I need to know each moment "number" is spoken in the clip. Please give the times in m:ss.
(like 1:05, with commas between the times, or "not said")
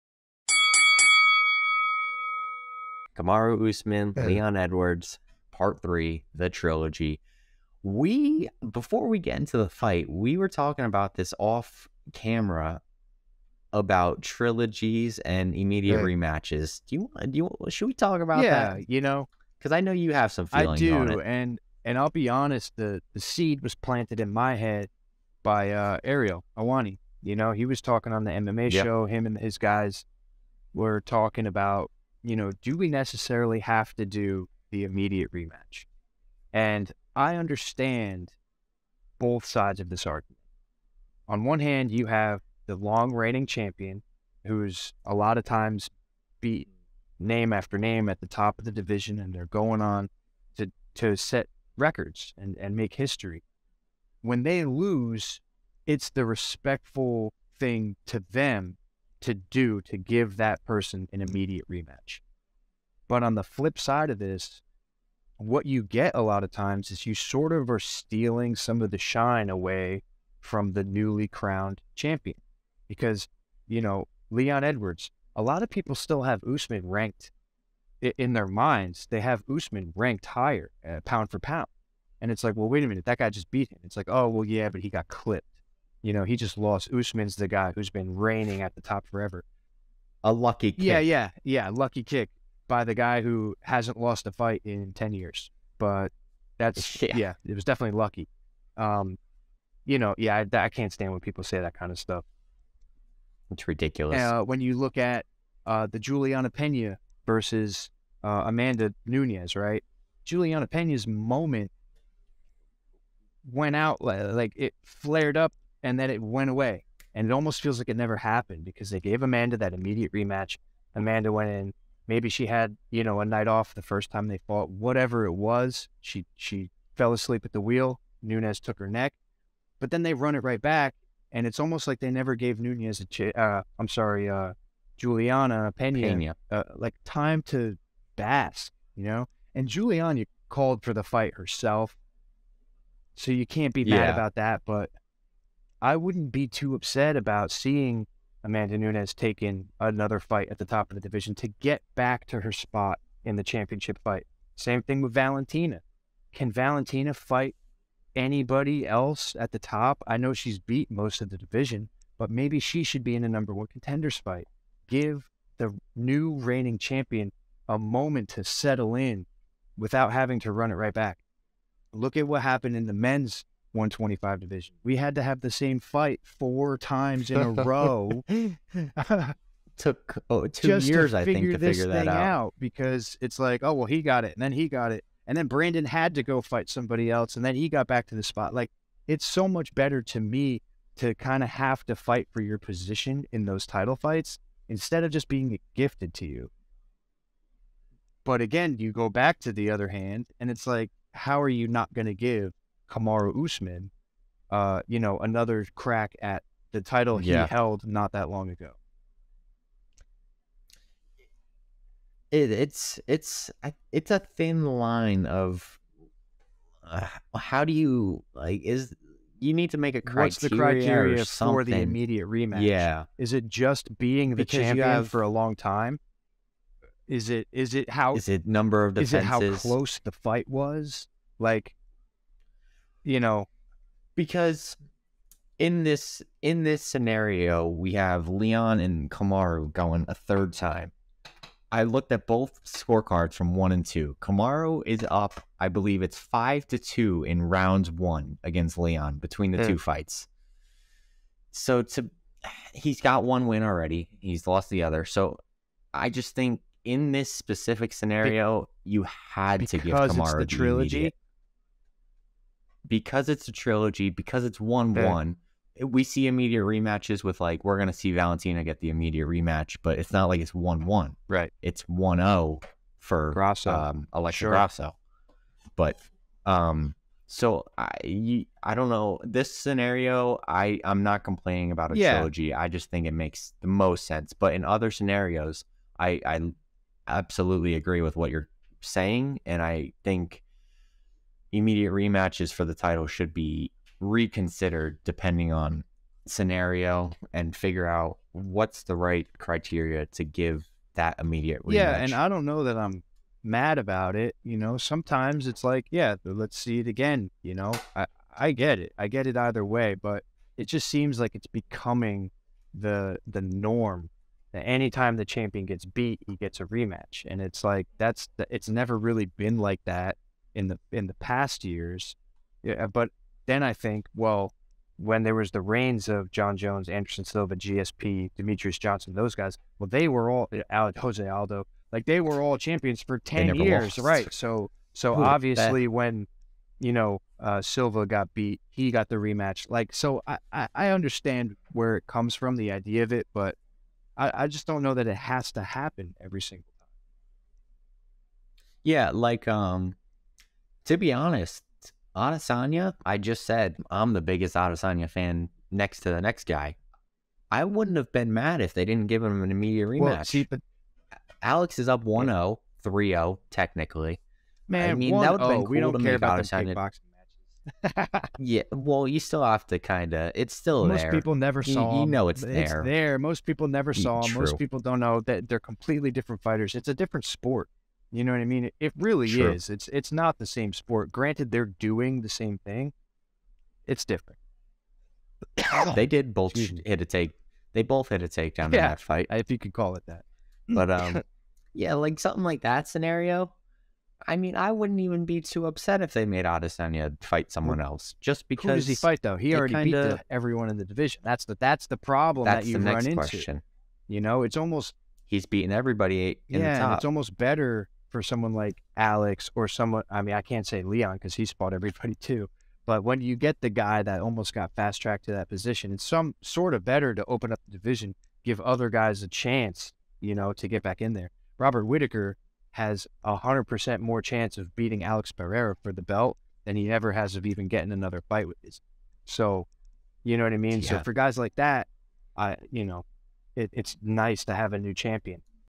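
2:43, 3:48.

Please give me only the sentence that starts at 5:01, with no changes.
Yeah, and I don't know that I'm mad about it.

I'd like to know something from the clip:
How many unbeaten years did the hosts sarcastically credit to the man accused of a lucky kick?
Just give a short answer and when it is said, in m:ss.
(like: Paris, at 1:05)
10, at 1:34.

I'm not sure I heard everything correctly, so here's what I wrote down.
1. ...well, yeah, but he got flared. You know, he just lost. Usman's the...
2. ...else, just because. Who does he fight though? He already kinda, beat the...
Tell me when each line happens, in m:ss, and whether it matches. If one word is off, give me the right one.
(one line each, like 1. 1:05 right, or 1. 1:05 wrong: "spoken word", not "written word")
1. 1:24 wrong: "clipped", not "flared"
2. 6:37 right.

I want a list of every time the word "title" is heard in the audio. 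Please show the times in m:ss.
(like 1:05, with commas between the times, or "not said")
3:13, 3:26, 4:52.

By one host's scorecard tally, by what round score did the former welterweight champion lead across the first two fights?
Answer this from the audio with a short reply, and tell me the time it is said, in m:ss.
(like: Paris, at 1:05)
5 to 2, at 4:06.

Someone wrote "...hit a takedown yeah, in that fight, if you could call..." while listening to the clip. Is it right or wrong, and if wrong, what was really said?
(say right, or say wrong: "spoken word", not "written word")
right.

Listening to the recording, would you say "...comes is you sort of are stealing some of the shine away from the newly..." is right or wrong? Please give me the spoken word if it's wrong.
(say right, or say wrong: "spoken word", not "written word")
wrong: "times", not "comes".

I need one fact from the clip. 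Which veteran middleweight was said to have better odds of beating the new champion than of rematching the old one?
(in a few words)
Robert Whitaker.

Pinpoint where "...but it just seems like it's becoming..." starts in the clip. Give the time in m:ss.
5:09.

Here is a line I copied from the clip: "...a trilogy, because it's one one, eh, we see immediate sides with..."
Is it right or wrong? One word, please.
wrong.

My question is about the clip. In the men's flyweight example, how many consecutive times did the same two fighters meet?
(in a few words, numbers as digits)
4.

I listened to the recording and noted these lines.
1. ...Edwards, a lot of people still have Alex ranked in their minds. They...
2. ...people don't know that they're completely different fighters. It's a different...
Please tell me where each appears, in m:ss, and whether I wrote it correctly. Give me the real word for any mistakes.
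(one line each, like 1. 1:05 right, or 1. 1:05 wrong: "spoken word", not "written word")
1. 1:14 wrong: "Usman", not "Alex"
2. 6:14 right.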